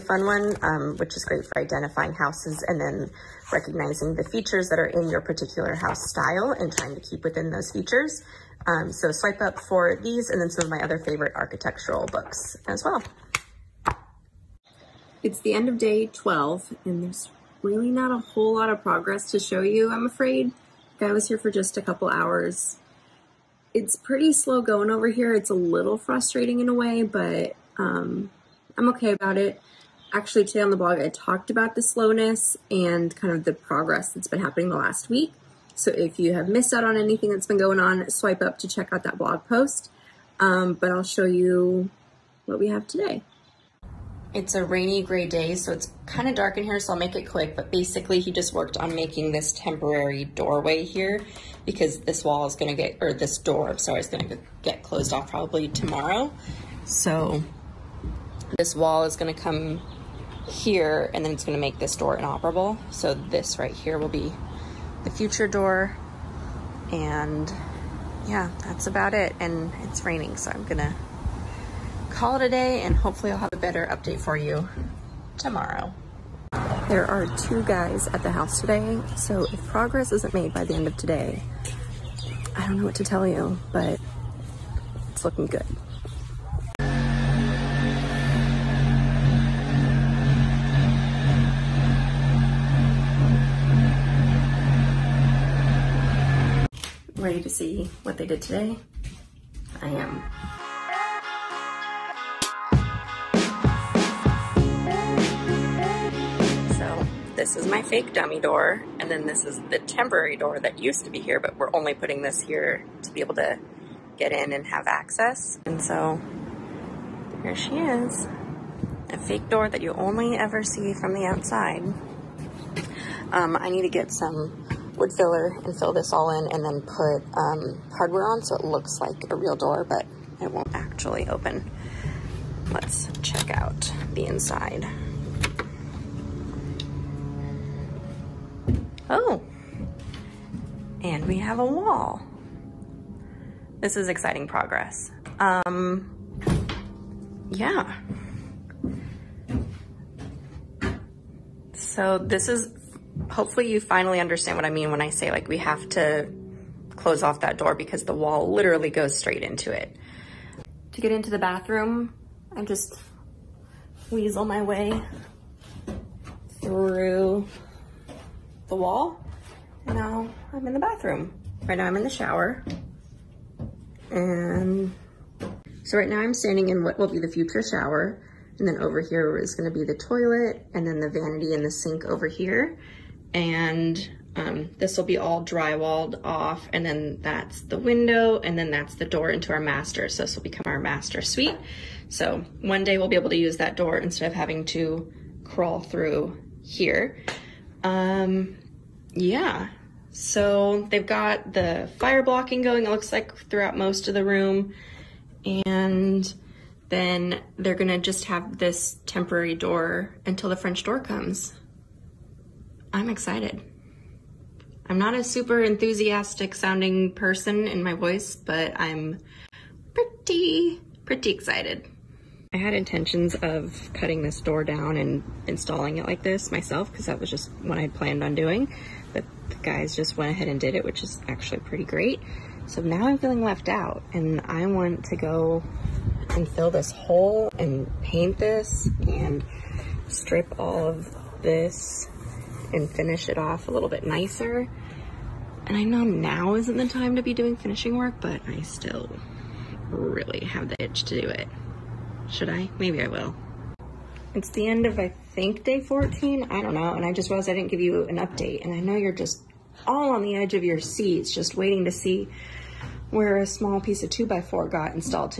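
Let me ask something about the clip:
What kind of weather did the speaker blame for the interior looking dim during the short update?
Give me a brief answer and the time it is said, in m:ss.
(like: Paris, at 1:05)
Rainy gray, at 0:44.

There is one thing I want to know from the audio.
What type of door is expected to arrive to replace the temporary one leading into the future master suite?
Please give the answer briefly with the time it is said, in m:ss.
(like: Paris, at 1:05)
French door, at 3:30.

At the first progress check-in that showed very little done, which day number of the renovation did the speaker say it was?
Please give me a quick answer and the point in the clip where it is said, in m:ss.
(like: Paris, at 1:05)
12, at 0:15.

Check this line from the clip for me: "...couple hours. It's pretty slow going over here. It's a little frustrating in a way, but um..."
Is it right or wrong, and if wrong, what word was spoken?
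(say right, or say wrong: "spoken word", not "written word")
right.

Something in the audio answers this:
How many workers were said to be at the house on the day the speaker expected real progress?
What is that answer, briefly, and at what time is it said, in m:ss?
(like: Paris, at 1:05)
2, at 1:17.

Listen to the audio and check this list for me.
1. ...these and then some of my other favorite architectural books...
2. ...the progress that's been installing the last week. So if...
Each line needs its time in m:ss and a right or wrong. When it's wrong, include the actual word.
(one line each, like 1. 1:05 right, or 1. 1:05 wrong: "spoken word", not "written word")
1. 0:10 right
2. 0:33 wrong: "happening", not "installing".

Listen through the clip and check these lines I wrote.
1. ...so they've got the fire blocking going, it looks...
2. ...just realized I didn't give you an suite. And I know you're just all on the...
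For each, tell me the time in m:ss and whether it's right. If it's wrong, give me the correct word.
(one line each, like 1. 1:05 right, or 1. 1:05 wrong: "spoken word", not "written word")
1. 3:20 right
2. 4:17 wrong: "update", not "suite".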